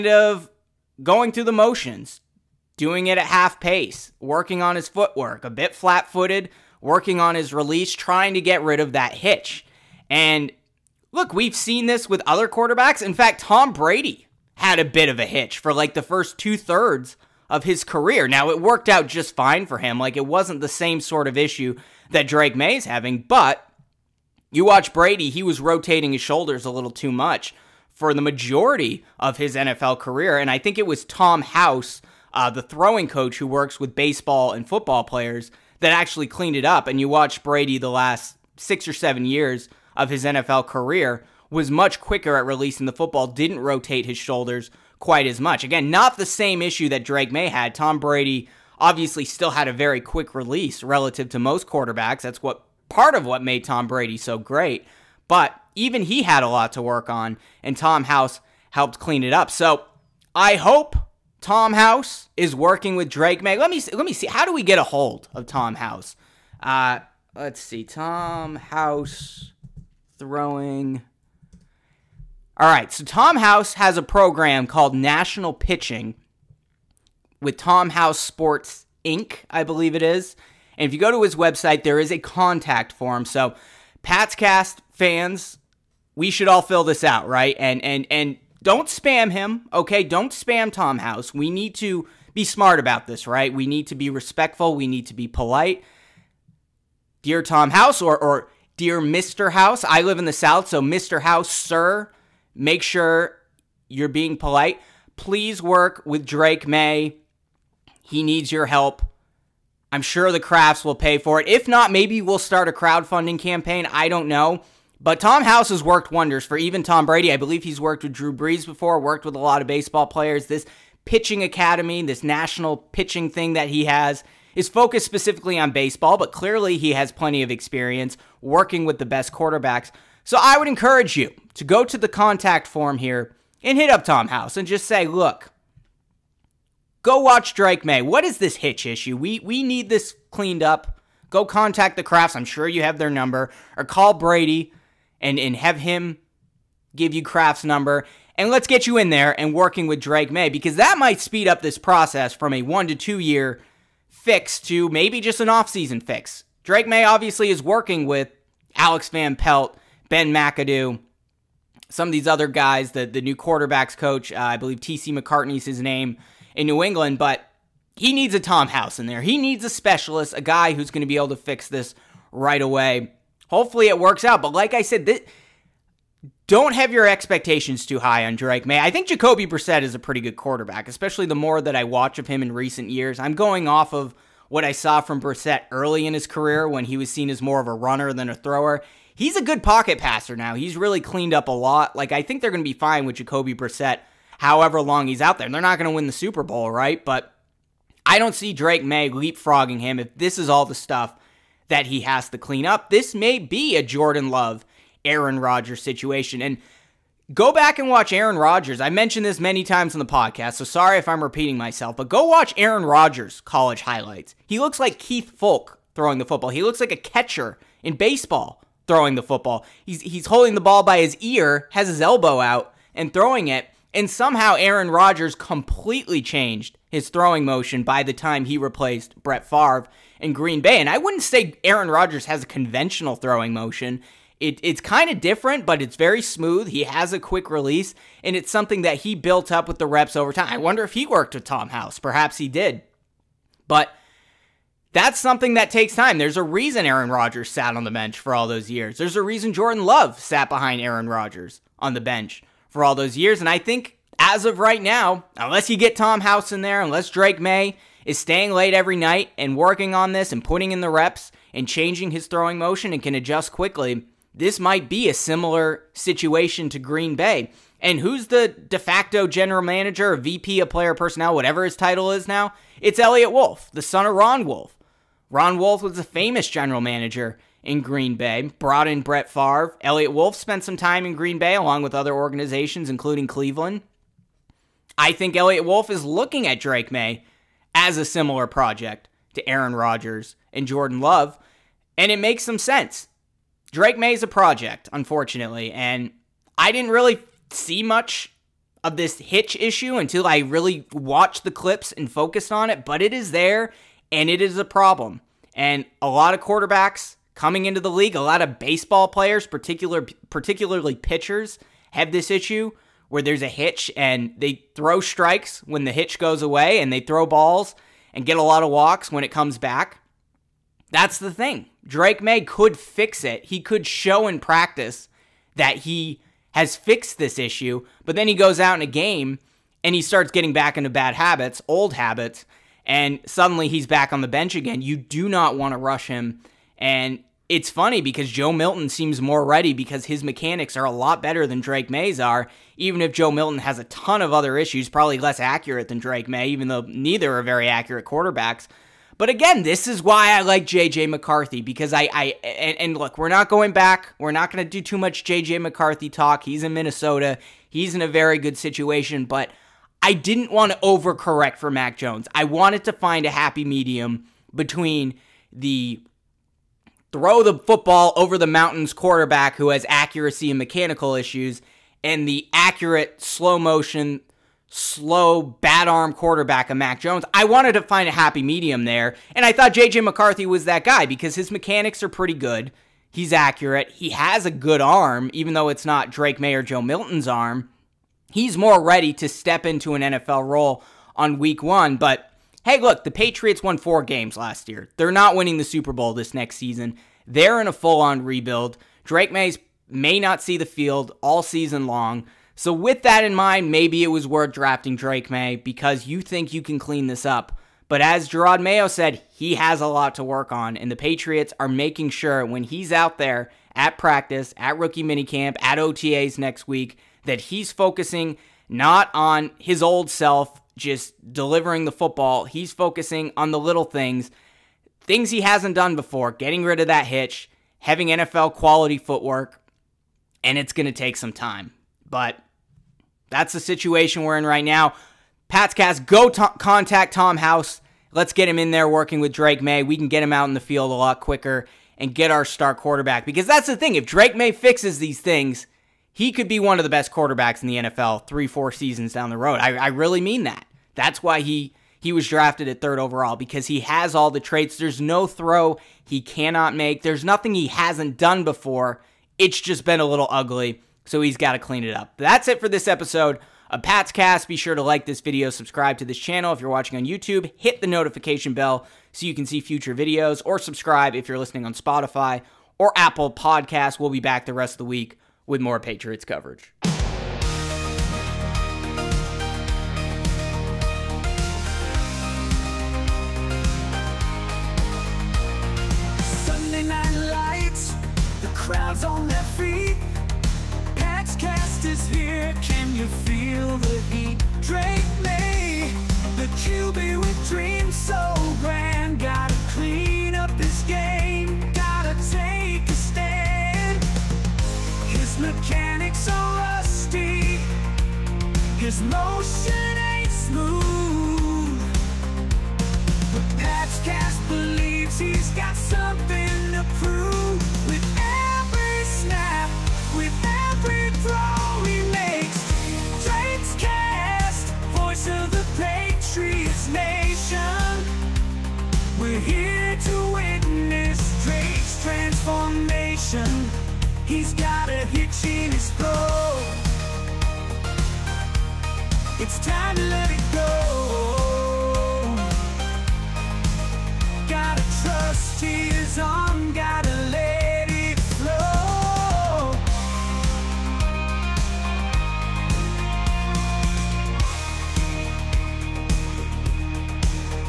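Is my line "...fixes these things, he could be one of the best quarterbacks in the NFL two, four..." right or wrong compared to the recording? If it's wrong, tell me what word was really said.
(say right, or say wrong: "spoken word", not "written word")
wrong: "three", not "two".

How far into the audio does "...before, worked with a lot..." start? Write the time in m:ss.
1:58.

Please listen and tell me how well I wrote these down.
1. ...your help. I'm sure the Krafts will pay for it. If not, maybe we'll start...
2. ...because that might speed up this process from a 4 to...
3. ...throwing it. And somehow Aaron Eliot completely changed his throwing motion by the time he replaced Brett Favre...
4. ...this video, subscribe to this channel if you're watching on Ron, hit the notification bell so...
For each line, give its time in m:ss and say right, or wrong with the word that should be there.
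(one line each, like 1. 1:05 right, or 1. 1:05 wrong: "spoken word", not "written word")
1. 1:48 right
2. 2:30 wrong: "1", not "4"
3. 3:43 wrong: "Rodgers", not "Eliot"
4. 7:45 wrong: "YouTube", not "Ron".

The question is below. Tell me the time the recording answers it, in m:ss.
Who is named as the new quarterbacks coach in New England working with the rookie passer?
2:44.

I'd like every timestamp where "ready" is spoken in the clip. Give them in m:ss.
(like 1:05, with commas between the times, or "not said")
5:39, 6:28.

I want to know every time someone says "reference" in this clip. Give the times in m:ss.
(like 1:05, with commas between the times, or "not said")
not said.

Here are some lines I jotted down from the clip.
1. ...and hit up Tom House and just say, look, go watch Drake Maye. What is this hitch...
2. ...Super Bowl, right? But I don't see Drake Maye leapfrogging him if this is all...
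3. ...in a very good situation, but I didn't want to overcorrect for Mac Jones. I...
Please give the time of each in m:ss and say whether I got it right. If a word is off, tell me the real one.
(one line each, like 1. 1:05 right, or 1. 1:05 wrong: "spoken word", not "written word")
1. 2:13 right
2. 3:16 right
3. 5:57 right.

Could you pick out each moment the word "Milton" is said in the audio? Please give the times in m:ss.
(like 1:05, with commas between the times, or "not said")
5:38, 5:43, 6:26.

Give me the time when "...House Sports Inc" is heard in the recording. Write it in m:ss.
1:17.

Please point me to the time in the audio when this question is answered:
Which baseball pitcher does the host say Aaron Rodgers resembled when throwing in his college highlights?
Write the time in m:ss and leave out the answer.
3:34.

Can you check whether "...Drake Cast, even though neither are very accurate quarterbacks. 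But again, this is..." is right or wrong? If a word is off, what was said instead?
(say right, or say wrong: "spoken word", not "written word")
wrong: "Maye", not "Cast".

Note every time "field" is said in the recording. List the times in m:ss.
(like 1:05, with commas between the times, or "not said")
6:40, 7:20.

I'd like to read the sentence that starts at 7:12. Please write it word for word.
But that's the situation we're in right now.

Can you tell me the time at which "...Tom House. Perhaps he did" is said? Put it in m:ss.
4:01.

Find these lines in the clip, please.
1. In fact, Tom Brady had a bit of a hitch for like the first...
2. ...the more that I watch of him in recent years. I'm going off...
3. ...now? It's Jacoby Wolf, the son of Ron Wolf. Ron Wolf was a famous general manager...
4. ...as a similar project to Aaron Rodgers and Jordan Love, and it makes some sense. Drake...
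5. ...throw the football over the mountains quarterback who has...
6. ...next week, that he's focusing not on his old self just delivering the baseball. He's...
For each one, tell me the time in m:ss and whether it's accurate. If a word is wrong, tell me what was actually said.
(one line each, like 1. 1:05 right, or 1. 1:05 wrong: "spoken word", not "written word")
1. 0:13 right
2. 3:01 right
3. 4:32 wrong: "Eliot", not "Jacoby"
4. 4:47 right
5. 6:07 right
6. 6:56 wrong: "football", not "baseball".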